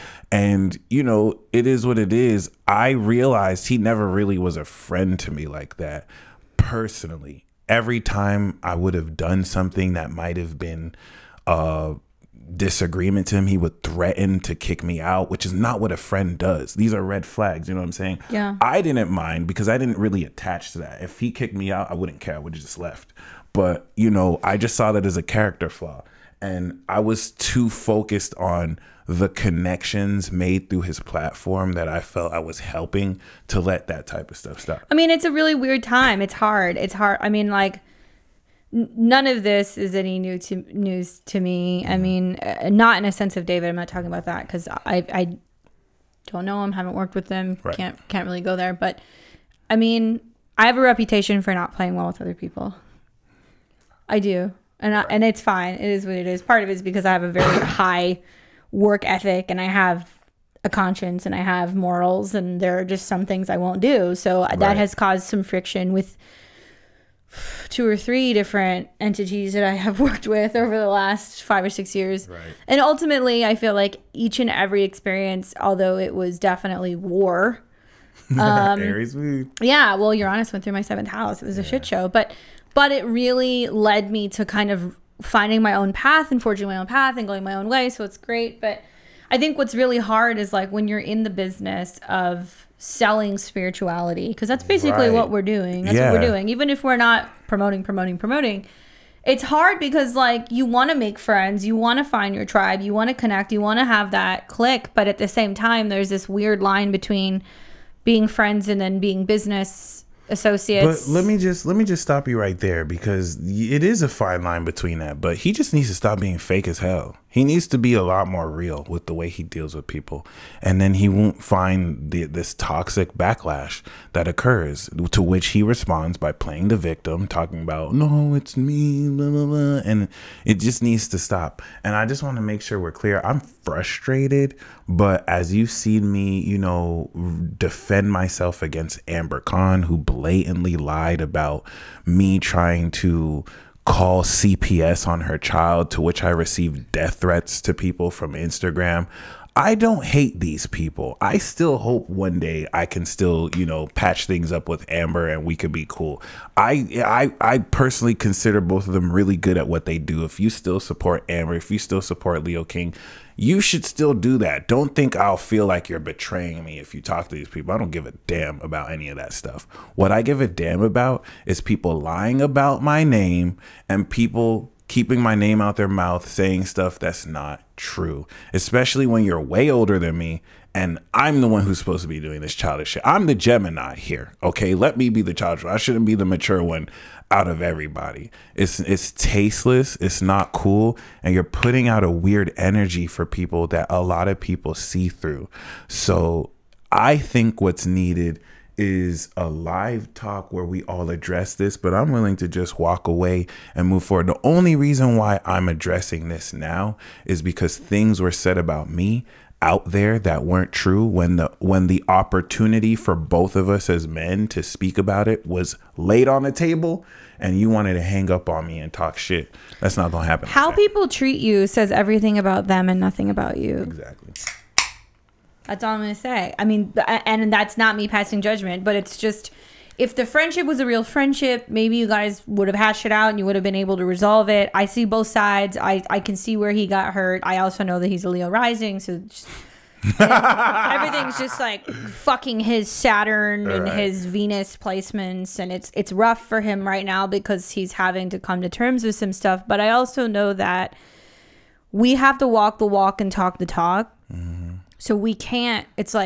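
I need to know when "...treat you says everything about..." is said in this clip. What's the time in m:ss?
3:41.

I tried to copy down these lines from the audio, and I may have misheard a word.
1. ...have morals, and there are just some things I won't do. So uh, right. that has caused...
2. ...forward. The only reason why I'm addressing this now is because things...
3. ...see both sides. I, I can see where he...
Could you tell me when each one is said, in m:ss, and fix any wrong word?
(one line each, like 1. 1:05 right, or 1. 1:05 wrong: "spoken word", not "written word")
1. 1:01 right
2. 3:24 right
3. 3:54 right.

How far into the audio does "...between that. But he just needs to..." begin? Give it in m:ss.
1:54.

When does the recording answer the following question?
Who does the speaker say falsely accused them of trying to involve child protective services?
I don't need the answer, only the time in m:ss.
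2:19.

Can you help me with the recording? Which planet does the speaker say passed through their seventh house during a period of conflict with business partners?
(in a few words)
Uranus.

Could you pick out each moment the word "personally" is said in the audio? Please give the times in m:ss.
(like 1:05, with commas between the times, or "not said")
0:06, 2:37.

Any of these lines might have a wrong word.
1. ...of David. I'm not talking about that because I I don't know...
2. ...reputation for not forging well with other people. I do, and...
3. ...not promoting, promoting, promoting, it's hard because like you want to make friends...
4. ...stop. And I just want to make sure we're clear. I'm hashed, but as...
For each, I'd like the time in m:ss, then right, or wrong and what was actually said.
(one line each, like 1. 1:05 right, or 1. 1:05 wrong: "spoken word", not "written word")
1. 0:43 right
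2. 0:50 wrong: "playing", not "forging"
3. 1:36 right
4. 2:11 wrong: "frustrated", not "hashed".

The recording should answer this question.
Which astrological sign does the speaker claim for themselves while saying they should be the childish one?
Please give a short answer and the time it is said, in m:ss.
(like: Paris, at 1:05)
Gemini, at 3:03.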